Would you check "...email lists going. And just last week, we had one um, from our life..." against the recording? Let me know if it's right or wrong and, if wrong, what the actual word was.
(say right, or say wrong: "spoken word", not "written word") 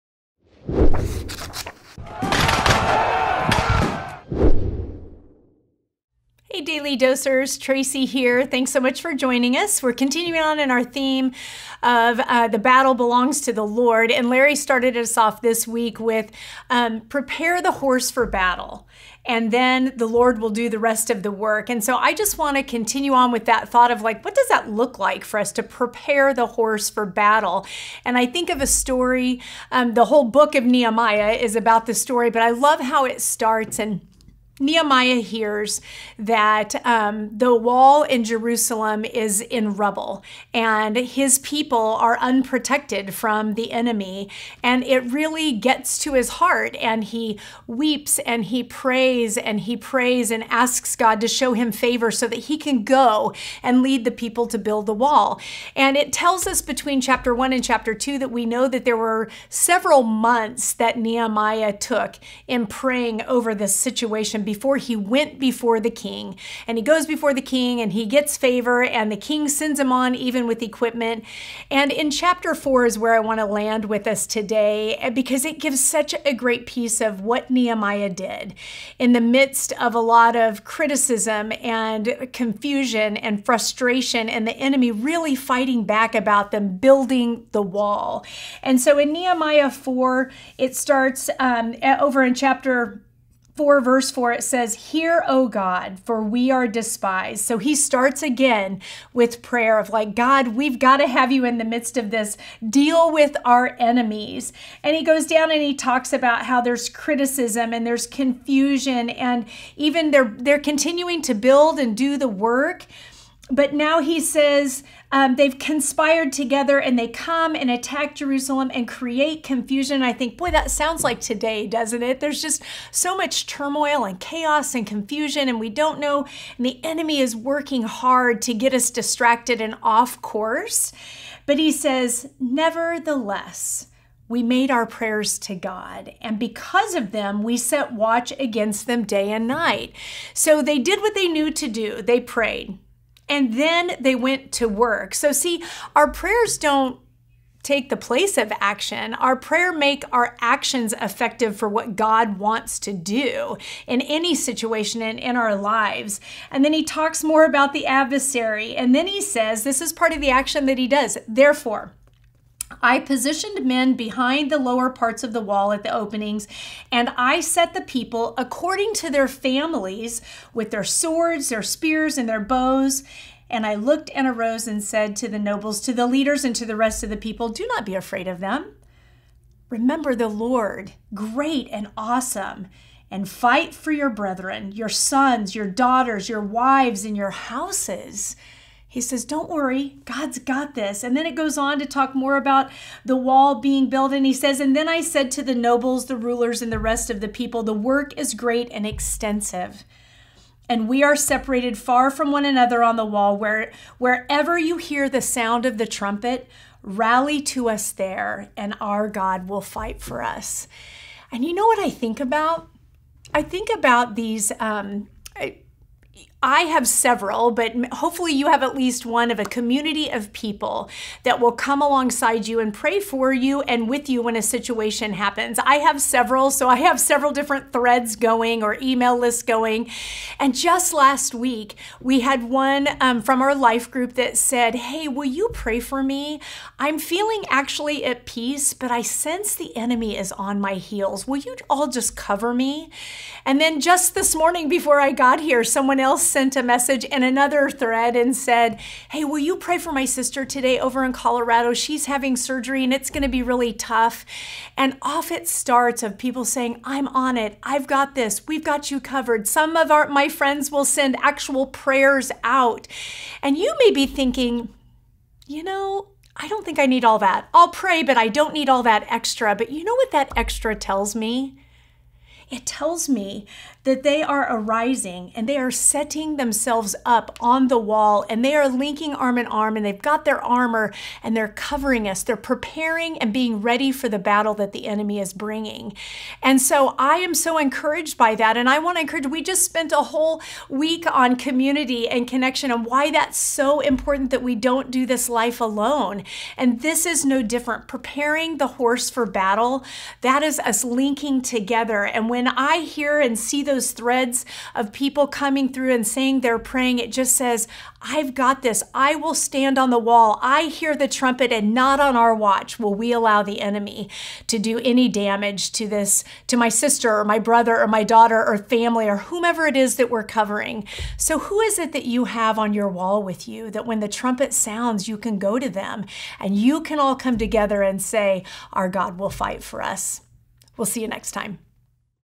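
right.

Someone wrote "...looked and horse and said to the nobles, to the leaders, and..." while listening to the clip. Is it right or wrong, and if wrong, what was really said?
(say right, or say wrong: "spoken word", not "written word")
wrong: "arose", not "horse".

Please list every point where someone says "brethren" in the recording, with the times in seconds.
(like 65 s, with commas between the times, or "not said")
184 s.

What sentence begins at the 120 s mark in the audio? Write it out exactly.
I think, boy, that sounds like today, doesn't it?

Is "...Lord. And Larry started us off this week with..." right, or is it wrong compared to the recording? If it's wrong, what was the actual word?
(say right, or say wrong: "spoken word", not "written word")
right.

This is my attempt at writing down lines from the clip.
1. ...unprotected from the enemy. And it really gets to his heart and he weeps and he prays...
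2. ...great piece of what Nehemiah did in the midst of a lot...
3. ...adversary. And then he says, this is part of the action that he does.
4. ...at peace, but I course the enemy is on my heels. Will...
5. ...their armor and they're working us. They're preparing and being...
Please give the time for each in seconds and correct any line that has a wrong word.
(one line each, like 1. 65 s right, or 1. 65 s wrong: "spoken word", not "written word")
1. 42 s right
2. 76 s right
3. 157 s right
4. 238 s wrong: "sense", not "course"
5. 280 s wrong: "covering", not "working".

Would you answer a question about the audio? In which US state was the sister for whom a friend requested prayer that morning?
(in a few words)
Colorado.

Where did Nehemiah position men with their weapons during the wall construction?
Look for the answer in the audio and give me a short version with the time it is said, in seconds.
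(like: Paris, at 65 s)
Lower parts of the wall, at 164 s.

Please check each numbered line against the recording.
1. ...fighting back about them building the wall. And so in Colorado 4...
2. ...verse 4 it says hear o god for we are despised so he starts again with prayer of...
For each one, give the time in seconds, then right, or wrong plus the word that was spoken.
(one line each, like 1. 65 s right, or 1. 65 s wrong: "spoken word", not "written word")
1. 85 s wrong: "Nehemiah", not "Colorado"
2. 93 s right.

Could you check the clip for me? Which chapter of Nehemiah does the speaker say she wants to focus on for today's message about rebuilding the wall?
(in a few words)
Chapter 4.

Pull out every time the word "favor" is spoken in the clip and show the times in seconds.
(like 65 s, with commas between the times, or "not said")
51 s, 68 s.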